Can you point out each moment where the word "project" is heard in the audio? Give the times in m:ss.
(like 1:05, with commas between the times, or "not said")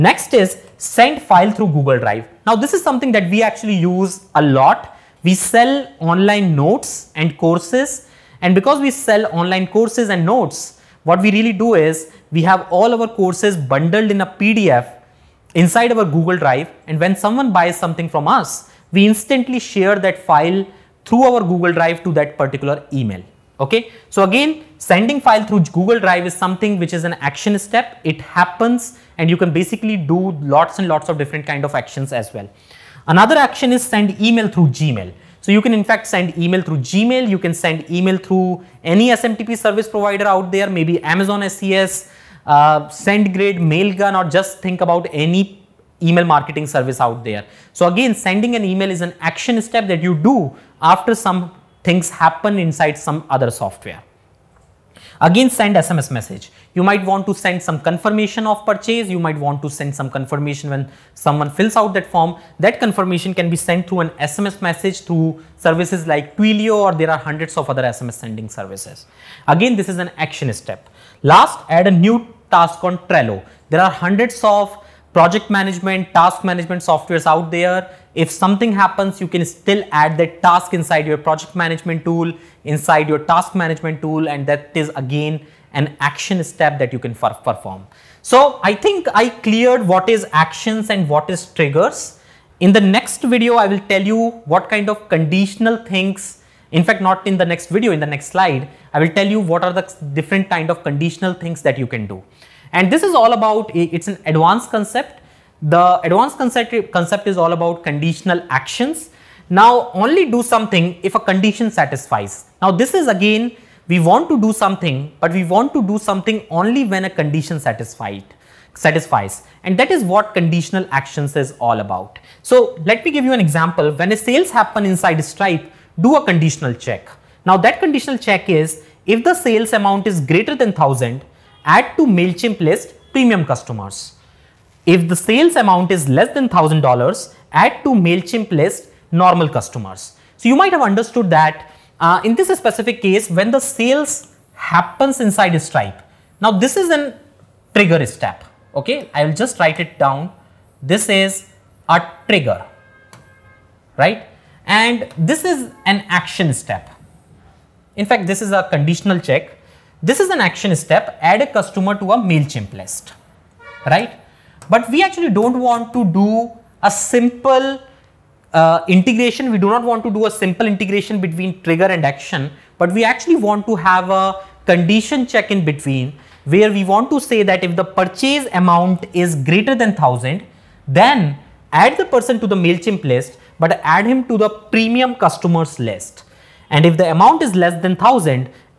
1:15, 1:21.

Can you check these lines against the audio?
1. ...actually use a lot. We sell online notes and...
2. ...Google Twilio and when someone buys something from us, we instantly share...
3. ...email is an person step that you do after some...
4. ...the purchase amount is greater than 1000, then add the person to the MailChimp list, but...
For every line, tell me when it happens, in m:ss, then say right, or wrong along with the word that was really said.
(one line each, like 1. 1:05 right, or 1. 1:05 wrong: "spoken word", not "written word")
1. 0:03 right
2. 0:16 wrong: "Drive", not "Twilio"
3. 0:48 wrong: "action", not "person"
4. 2:57 right.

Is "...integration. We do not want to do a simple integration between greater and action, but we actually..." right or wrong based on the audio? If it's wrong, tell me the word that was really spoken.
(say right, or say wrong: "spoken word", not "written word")
wrong: "trigger", not "greater".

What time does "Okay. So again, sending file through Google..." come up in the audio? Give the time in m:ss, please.
0:23.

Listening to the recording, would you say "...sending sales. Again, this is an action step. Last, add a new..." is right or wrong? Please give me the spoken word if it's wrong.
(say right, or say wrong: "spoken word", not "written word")
wrong: "services", not "sales".